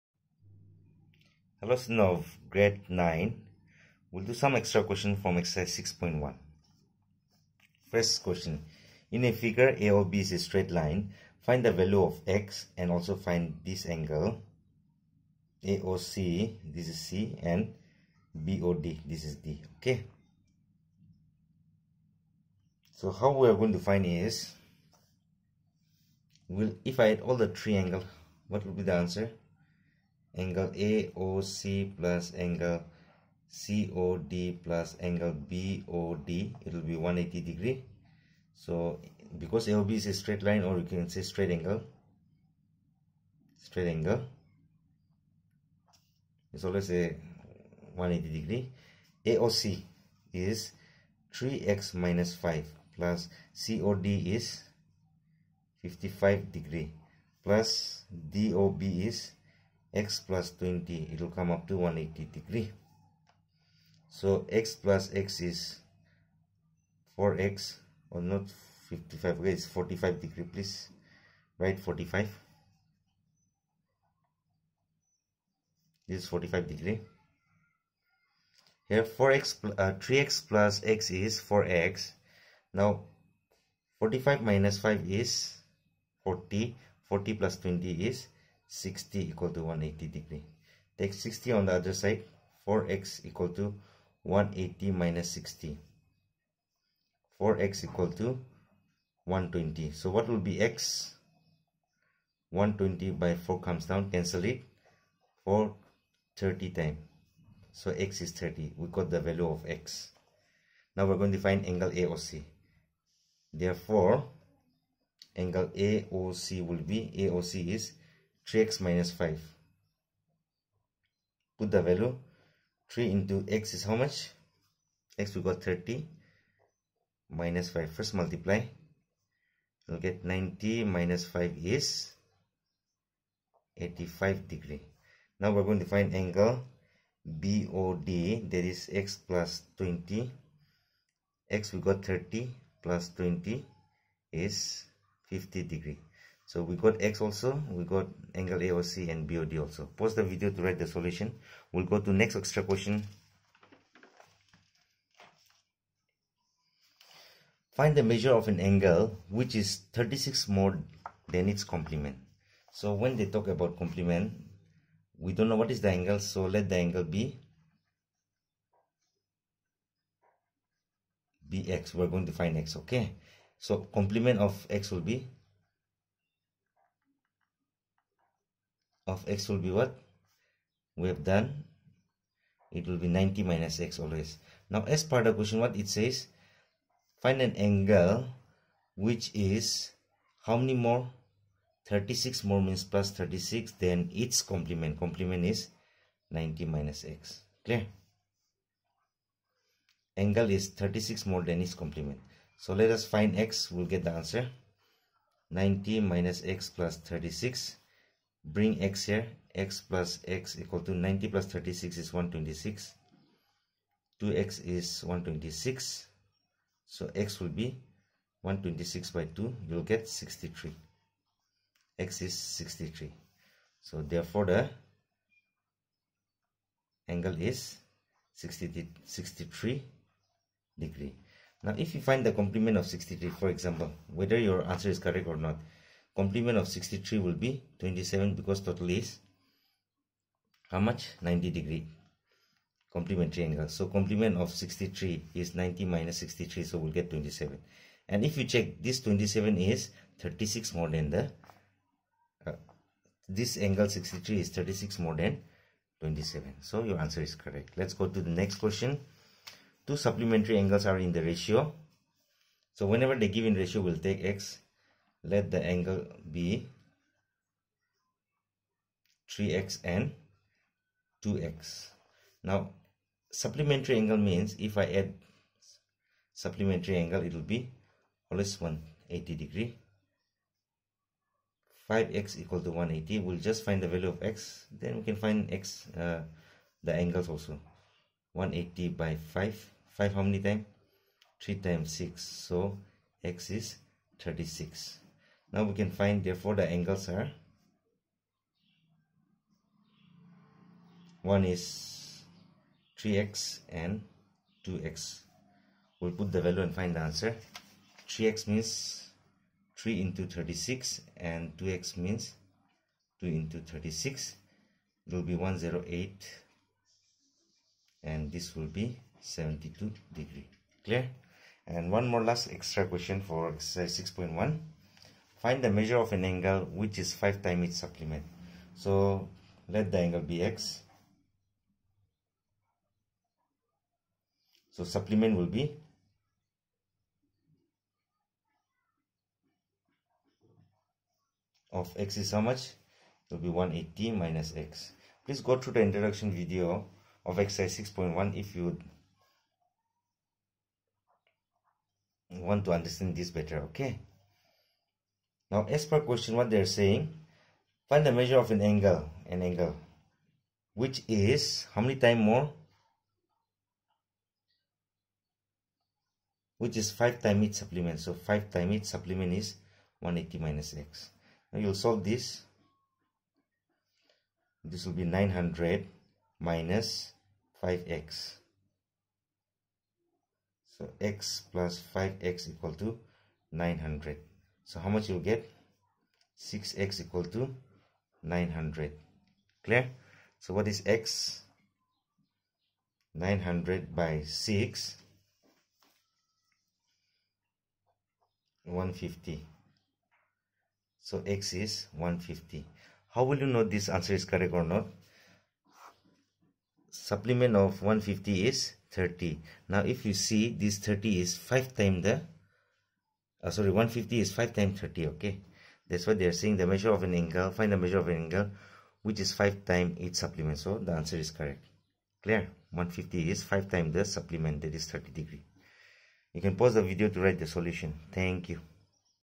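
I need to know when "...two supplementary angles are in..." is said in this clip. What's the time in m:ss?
4:19.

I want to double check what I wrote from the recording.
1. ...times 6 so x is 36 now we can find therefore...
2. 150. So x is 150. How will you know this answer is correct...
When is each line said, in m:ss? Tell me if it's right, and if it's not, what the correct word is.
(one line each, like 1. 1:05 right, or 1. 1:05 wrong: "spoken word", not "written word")
1. 4:51 right
2. 6:38 right.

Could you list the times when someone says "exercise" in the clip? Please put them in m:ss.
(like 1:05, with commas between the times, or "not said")
0:05, 5:23, 5:47.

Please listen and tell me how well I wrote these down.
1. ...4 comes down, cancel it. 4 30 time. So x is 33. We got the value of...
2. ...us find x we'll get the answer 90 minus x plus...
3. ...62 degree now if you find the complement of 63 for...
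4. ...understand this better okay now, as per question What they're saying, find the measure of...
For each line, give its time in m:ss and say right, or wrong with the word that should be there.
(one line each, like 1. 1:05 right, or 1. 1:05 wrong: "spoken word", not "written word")
1. 1:43 wrong: "30", not "33"
2. 3:22 right
3. 3:48 wrong: "63", not "62"
4. 5:52 right.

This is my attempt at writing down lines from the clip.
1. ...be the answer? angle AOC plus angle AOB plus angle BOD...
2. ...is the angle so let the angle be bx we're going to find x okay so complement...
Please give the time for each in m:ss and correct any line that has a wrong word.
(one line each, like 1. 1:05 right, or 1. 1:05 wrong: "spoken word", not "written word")
1. 0:28 wrong: "COD", not "AOB"
2. 2:45 right.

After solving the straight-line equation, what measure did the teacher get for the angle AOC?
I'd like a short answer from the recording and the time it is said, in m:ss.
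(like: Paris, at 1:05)
85 degrees, at 2:13.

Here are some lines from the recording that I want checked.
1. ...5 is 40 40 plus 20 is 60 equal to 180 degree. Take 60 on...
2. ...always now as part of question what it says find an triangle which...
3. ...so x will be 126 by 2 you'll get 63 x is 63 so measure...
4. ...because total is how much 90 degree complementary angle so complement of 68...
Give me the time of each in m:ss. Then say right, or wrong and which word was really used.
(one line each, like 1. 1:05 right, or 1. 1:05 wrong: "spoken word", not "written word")
1. 1:24 right
2. 3:03 wrong: "angle", not "triangle"
3. 3:36 wrong: "therefore", not "measure"
4. 3:58 wrong: "63", not "68".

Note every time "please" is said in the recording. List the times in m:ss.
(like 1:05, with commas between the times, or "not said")
1:10, 5:45.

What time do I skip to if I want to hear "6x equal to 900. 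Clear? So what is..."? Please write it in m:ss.
6:26.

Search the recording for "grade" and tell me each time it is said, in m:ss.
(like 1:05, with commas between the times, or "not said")
0:02.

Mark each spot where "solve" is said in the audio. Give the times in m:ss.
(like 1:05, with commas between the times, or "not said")
6:11.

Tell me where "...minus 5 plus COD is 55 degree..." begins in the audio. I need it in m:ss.
0:51.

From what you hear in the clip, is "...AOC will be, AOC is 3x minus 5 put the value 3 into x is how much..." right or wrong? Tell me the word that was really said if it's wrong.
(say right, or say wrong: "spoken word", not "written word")
right.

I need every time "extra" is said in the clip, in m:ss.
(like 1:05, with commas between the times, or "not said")
0:04, 2:32, 5:22.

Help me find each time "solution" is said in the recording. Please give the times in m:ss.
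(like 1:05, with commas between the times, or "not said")
2:30, 7:07.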